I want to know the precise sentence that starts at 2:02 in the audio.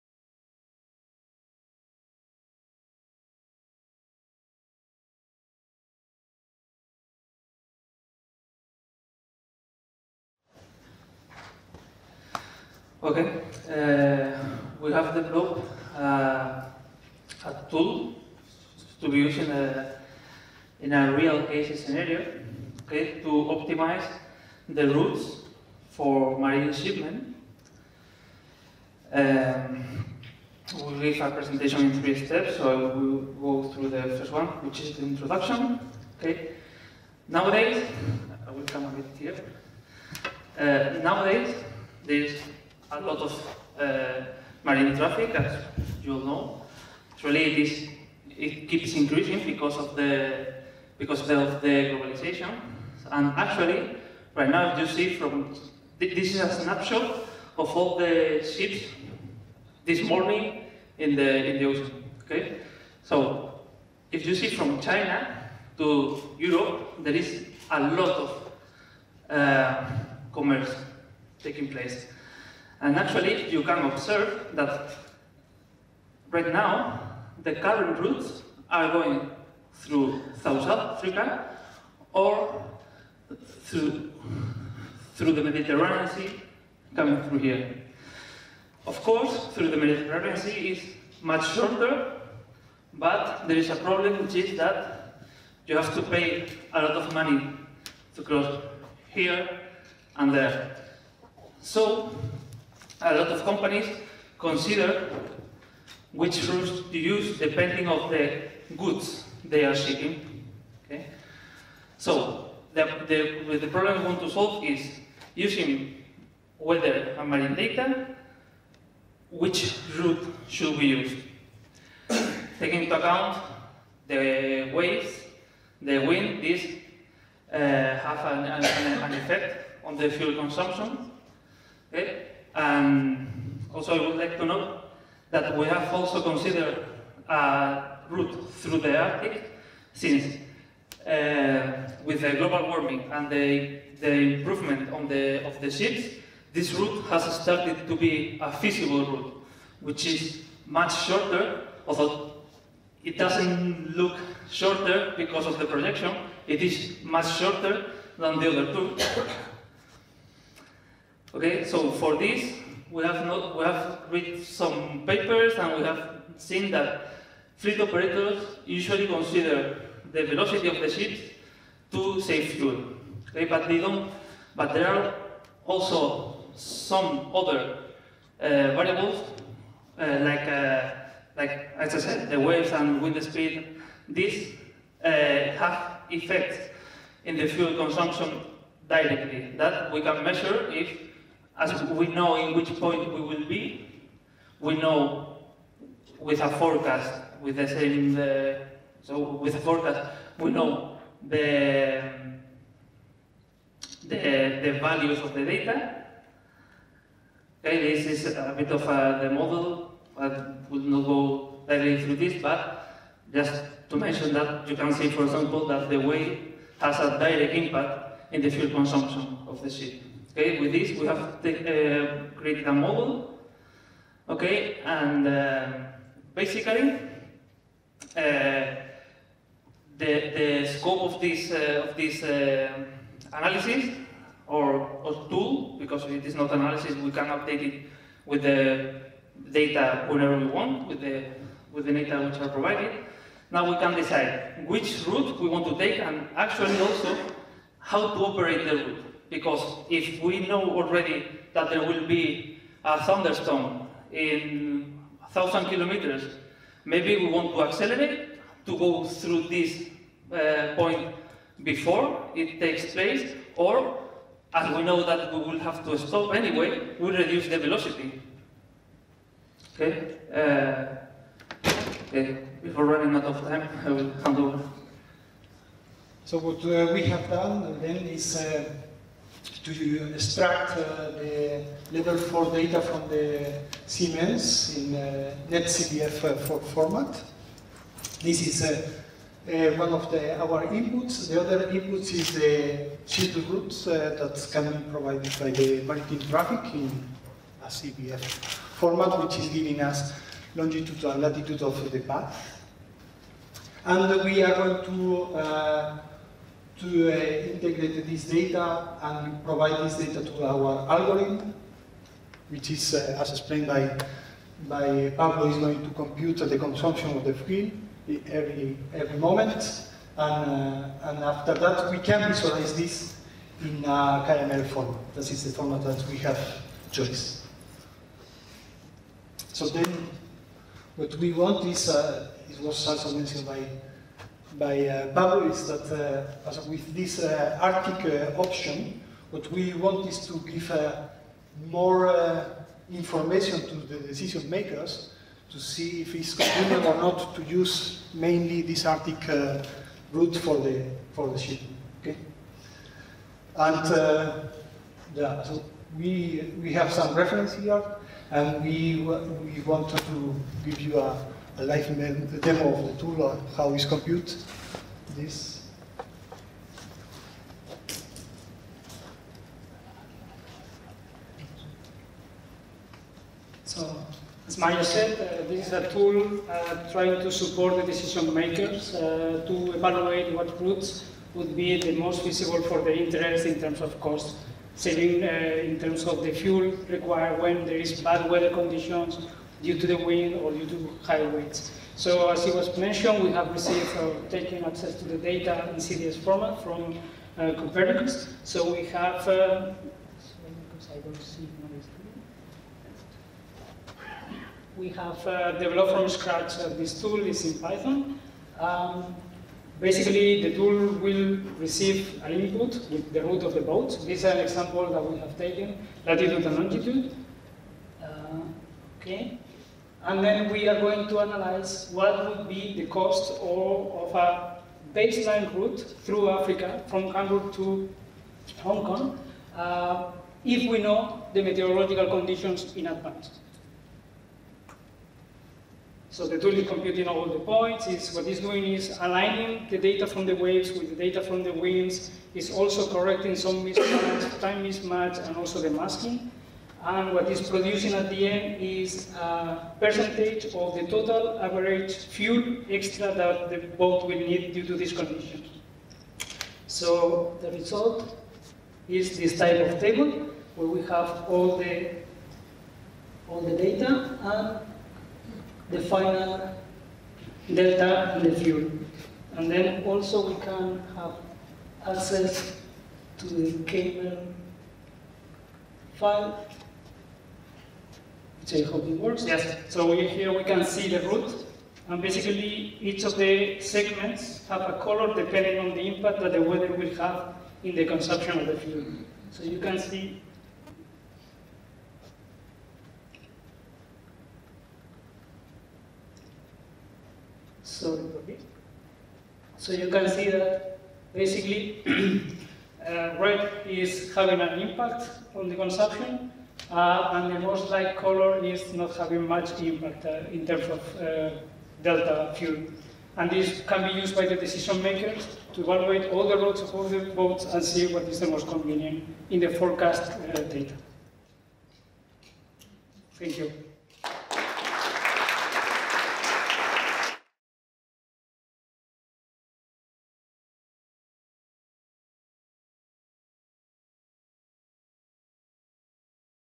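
Taking into account the waves, the wind, this uh, have an, an, an effect on the fuel consumption.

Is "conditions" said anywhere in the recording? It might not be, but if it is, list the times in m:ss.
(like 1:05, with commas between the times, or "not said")
6:28, 7:12, 7:34.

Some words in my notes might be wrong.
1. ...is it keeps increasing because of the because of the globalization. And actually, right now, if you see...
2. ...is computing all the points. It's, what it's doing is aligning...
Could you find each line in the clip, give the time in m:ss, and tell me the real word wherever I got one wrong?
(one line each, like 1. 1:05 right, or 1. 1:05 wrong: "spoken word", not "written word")
1. 0:47 right
2. 7:16 right.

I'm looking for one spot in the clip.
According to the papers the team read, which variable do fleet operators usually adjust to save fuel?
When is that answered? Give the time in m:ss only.
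2:50.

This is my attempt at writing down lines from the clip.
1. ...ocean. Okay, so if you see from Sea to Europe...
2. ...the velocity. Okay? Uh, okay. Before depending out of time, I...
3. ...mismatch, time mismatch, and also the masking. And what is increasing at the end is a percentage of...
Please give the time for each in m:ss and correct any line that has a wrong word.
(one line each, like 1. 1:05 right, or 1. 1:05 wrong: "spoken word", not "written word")
1. 1:01 wrong: "China", not "Sea"
2. 4:27 wrong: "running", not "depending"
3. 7:23 wrong: "producing", not "increasing".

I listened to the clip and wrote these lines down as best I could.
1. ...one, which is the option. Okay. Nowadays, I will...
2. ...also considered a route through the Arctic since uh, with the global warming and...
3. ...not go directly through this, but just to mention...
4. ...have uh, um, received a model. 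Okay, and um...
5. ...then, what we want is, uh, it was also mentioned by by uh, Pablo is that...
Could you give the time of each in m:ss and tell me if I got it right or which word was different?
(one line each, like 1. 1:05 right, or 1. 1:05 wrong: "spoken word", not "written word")
1. 0:34 wrong: "introduction", not "option"
2. 2:15 right
3. 3:30 right
4. 3:41 wrong: "created", not "received"
5. 5:29 right.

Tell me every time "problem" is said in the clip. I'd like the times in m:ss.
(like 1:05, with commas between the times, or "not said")
1:33, 1:53.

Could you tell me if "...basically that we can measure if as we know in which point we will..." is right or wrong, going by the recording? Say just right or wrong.
wrong.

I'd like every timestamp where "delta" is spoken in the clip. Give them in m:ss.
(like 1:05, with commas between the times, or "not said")
7:47, 8:31.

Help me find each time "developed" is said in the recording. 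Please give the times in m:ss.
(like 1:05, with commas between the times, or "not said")
0:15, 6:45.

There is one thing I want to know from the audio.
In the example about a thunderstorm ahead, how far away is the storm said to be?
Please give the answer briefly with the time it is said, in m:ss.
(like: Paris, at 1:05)
1,000 kilometers, at 4:15.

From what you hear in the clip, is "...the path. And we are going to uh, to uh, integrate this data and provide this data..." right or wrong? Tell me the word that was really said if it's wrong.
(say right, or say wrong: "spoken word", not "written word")
right.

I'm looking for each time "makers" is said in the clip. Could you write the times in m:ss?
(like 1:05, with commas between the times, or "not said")
5:44, 6:18, 8:34.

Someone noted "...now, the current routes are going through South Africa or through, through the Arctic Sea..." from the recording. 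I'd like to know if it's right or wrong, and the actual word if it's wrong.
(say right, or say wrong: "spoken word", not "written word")
wrong: "Mediterranean", not "Arctic".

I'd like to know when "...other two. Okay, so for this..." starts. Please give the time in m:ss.
2:38.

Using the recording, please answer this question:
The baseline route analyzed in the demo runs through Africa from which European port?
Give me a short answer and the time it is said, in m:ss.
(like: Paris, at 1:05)
Hamburg, at 7:07.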